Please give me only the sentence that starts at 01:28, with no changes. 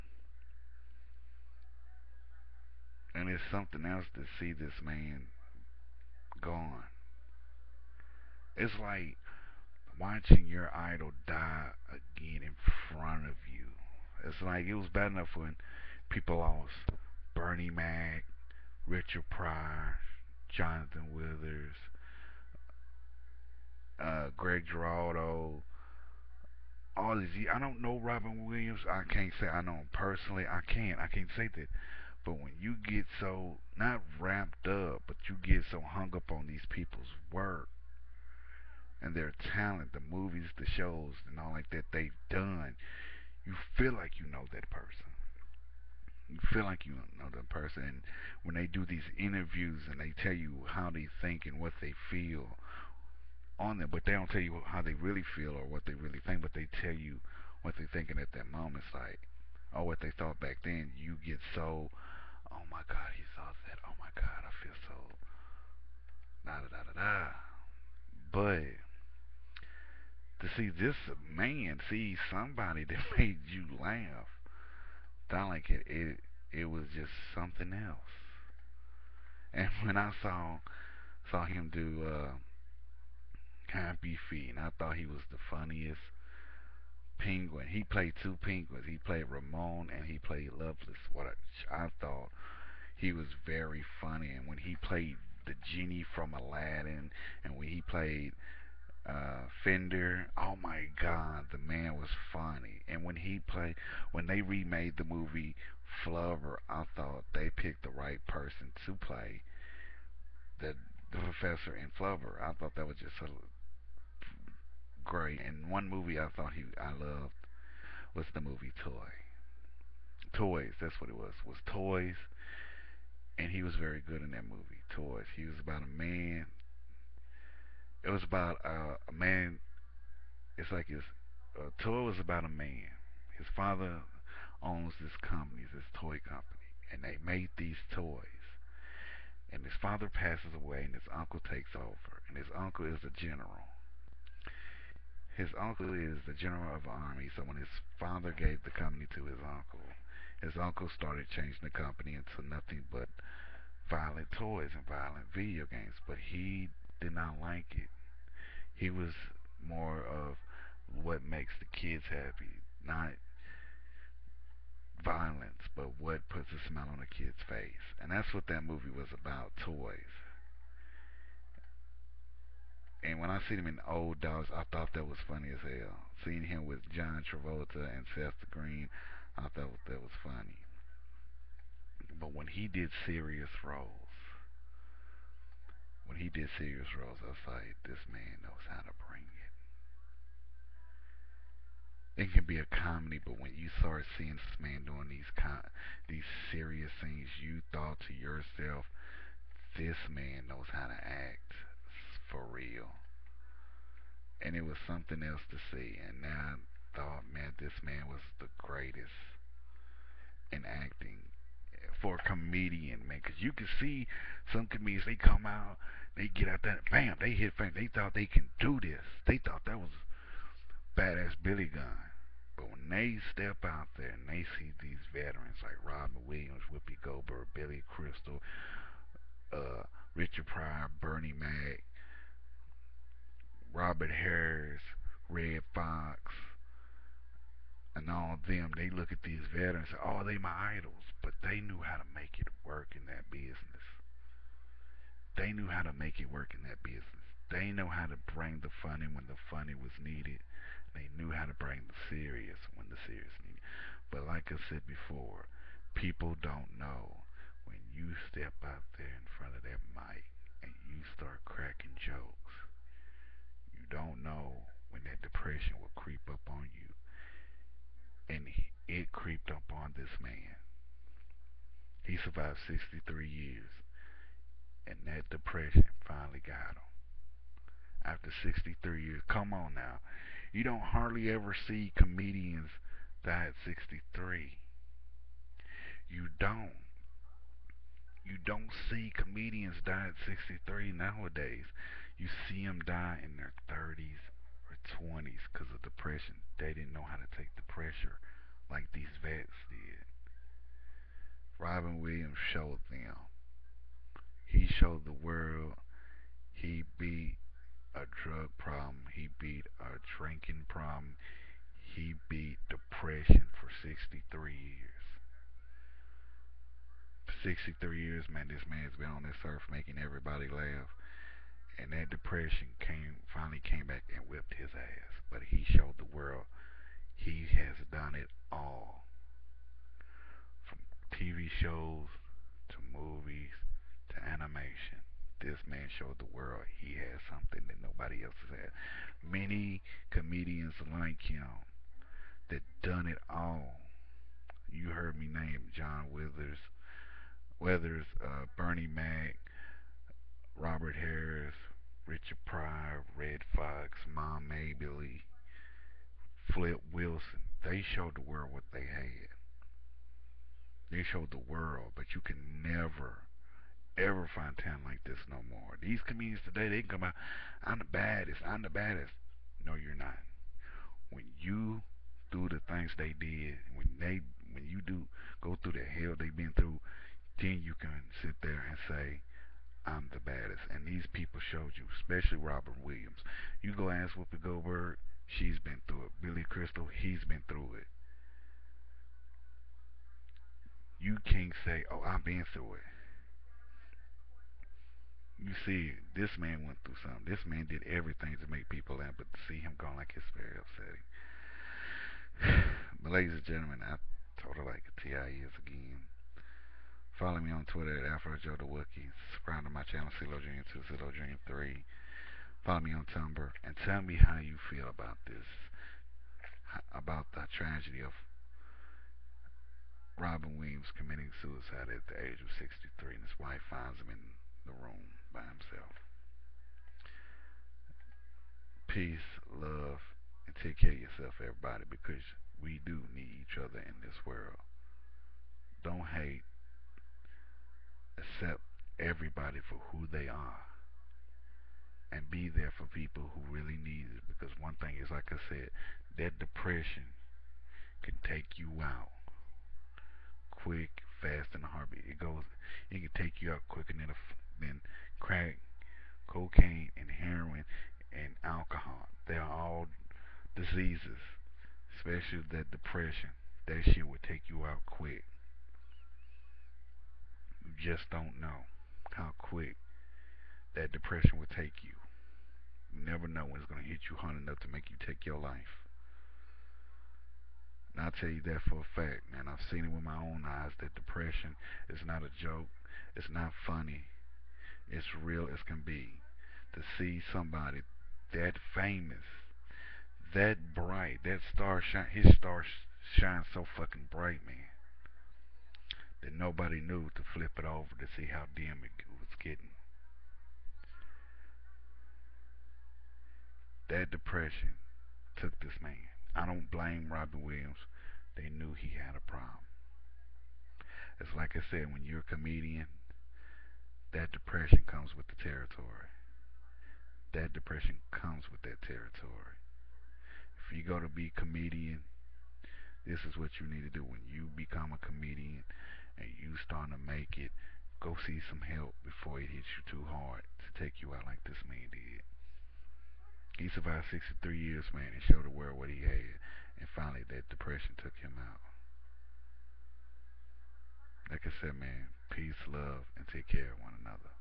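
He played Ramon and he played Lovelace.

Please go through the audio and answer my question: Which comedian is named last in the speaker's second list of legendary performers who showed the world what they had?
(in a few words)
Flip Wilson.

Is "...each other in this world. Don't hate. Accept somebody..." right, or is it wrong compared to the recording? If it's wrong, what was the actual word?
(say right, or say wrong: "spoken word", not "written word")
wrong: "everybody", not "somebody".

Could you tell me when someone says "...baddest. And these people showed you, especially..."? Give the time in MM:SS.
06:20.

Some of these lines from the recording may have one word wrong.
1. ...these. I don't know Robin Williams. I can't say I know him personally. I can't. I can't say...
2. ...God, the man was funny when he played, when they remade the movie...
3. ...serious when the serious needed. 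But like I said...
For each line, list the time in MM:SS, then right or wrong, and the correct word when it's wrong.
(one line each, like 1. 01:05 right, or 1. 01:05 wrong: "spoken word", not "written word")
1. 00:27 right
2. 01:40 right
3. 04:12 right.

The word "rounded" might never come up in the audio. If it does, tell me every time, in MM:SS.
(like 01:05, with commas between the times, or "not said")
not said.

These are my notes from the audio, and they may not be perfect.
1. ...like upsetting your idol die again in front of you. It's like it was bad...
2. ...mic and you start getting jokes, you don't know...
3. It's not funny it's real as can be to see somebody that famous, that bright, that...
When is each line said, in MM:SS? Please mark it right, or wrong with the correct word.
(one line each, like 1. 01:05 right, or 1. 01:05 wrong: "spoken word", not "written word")
1. 00:08 wrong: "watching", not "upsetting"
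2. 04:19 wrong: "cracking", not "getting"
3. 08:03 right.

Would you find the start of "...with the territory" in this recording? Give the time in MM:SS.
08:35.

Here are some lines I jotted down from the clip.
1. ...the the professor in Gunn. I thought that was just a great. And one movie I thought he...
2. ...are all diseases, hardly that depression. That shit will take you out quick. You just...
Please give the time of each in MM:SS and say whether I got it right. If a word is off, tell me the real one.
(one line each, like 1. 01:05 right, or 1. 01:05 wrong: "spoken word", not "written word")
1. 01:50 wrong: "Flubber", not "Gunn"
2. 07:39 wrong: "especially", not "hardly".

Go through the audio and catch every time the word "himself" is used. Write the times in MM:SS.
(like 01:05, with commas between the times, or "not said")
07:05.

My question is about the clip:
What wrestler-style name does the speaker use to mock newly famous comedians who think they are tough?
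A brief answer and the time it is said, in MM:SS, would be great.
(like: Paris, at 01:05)
Billy Gunn, at 03:41.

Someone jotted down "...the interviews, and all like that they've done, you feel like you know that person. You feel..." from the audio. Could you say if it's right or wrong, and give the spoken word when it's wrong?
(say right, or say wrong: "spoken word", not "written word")
wrong: "shows", not "interviews".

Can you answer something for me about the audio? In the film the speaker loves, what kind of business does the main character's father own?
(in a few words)
toy company.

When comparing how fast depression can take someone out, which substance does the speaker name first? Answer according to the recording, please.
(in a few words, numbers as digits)
crack.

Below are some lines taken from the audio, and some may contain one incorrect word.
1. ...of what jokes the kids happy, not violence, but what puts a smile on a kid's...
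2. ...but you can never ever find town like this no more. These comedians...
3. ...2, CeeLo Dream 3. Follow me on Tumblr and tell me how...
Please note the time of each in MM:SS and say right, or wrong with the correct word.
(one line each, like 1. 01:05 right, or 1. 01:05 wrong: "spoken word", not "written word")
1. 02:40 wrong: "makes", not "jokes"
2. 06:01 right
3. 06:50 right.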